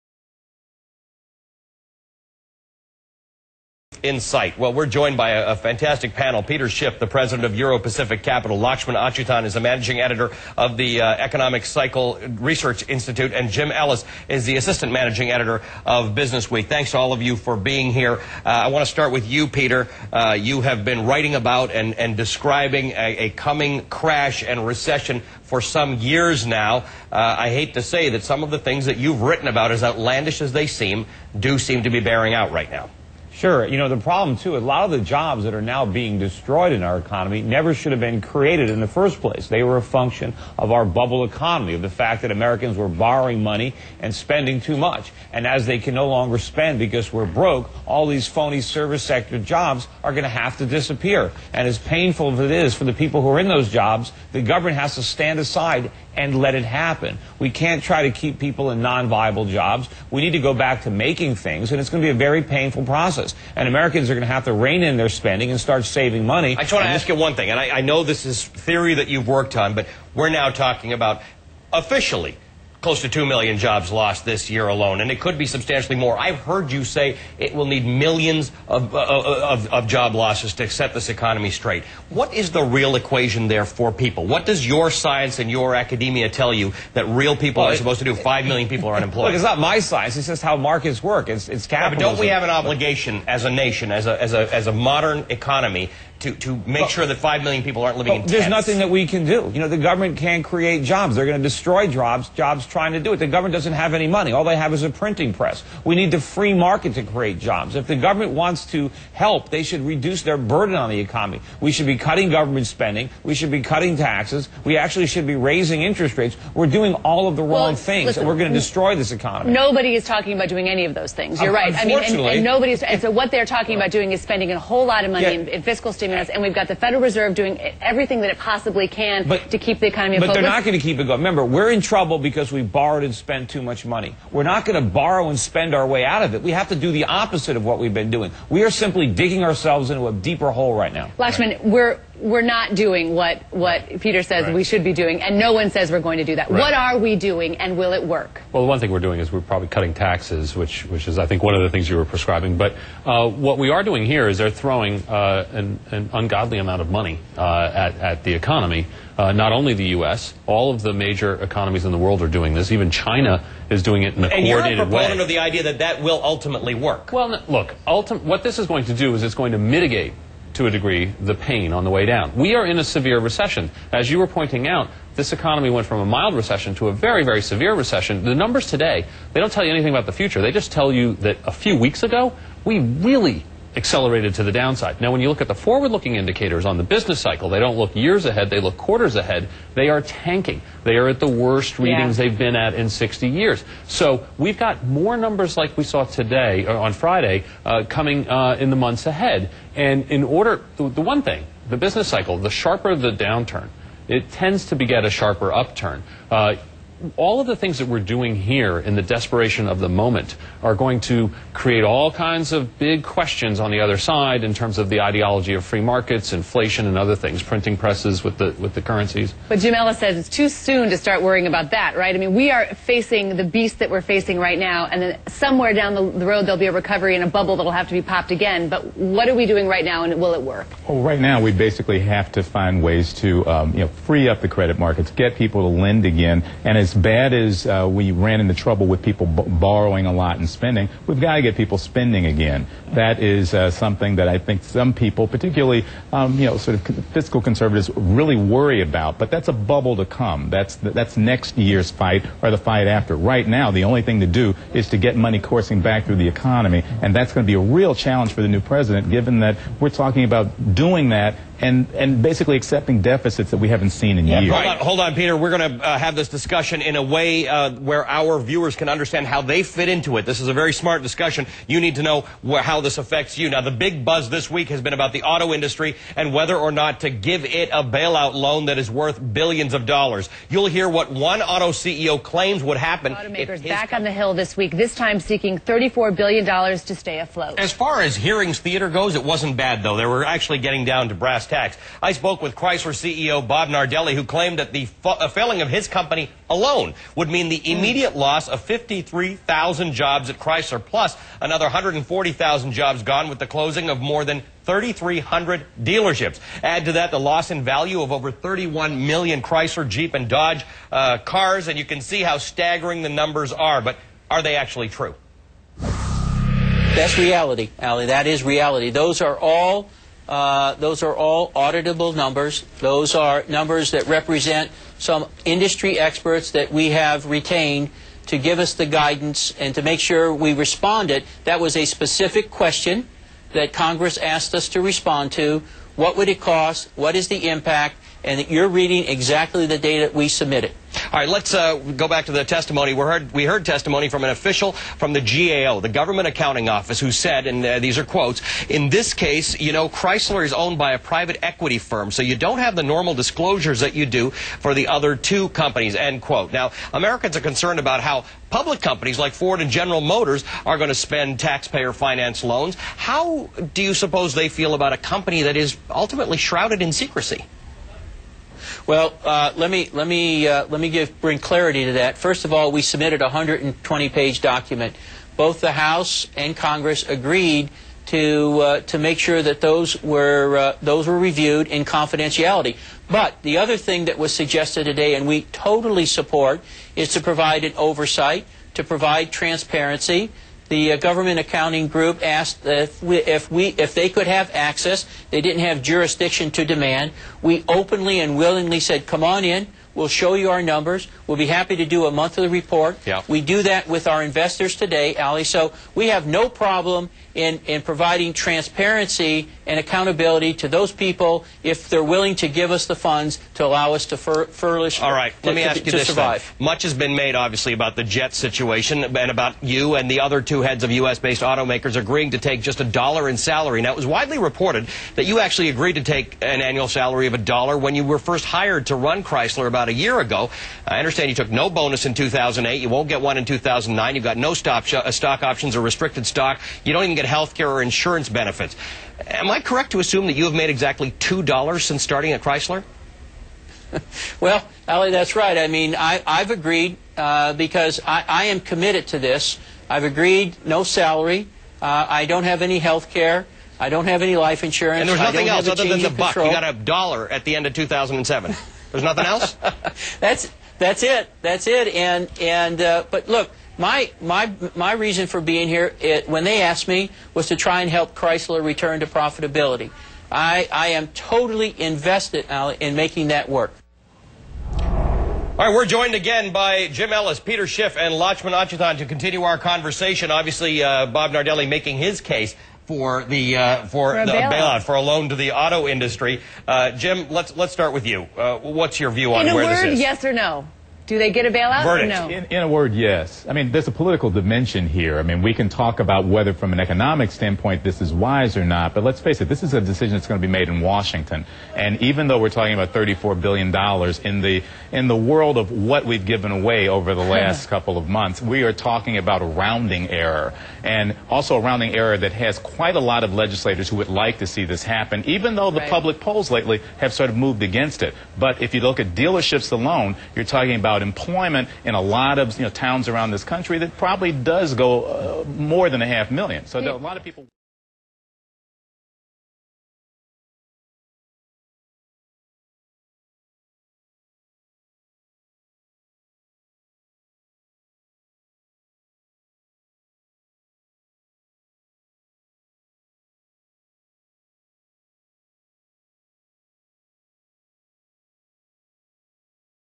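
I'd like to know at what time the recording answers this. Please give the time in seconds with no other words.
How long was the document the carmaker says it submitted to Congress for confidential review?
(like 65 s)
373 s.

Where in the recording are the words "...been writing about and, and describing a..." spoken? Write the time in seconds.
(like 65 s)
20 s.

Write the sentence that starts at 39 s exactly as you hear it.
They were a function of our bubble economy, of the fact that Americans were borrowing money and spending too much.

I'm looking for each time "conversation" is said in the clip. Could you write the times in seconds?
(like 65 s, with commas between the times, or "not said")
479 s.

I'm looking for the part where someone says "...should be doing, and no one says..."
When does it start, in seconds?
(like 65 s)
144 s.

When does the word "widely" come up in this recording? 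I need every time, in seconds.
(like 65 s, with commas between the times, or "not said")
424 s.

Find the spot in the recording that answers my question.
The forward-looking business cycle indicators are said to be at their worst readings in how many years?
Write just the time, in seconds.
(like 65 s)
192 s.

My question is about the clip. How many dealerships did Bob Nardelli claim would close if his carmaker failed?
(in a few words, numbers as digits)
more than 3,300.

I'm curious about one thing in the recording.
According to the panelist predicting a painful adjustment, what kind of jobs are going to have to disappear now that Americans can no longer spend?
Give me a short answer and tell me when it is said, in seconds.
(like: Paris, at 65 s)
phony service sector jobs, at 48 s.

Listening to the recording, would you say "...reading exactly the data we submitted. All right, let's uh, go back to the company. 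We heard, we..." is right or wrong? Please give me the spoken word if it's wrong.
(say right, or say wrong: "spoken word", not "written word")
wrong: "testimony", not "company".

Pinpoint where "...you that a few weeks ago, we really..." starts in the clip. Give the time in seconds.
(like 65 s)
180 s.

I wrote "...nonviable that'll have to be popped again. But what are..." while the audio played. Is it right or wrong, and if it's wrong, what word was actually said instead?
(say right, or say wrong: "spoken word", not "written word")
wrong: "bubble", not "nonviable".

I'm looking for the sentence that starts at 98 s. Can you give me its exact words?
There's nothing that we can do.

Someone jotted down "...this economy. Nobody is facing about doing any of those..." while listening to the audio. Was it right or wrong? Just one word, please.
wrong.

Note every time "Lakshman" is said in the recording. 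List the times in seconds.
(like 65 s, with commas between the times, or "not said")
8 s, 141 s, 478 s.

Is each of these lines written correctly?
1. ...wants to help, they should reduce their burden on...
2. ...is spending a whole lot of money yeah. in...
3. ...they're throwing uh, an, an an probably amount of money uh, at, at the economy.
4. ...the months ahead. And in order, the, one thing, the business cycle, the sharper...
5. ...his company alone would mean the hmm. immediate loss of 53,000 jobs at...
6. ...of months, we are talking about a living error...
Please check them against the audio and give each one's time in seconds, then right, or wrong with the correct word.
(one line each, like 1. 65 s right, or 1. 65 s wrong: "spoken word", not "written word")
1. 108 s right
2. 124 s right
3. 154 s wrong: "ungodly", not "probably"
4. 198 s right
5. 295 s right
6. 507 s wrong: "rounding", not "living".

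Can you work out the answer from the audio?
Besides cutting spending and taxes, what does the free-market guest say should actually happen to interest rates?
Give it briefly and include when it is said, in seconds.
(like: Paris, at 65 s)
raising, at 115 s.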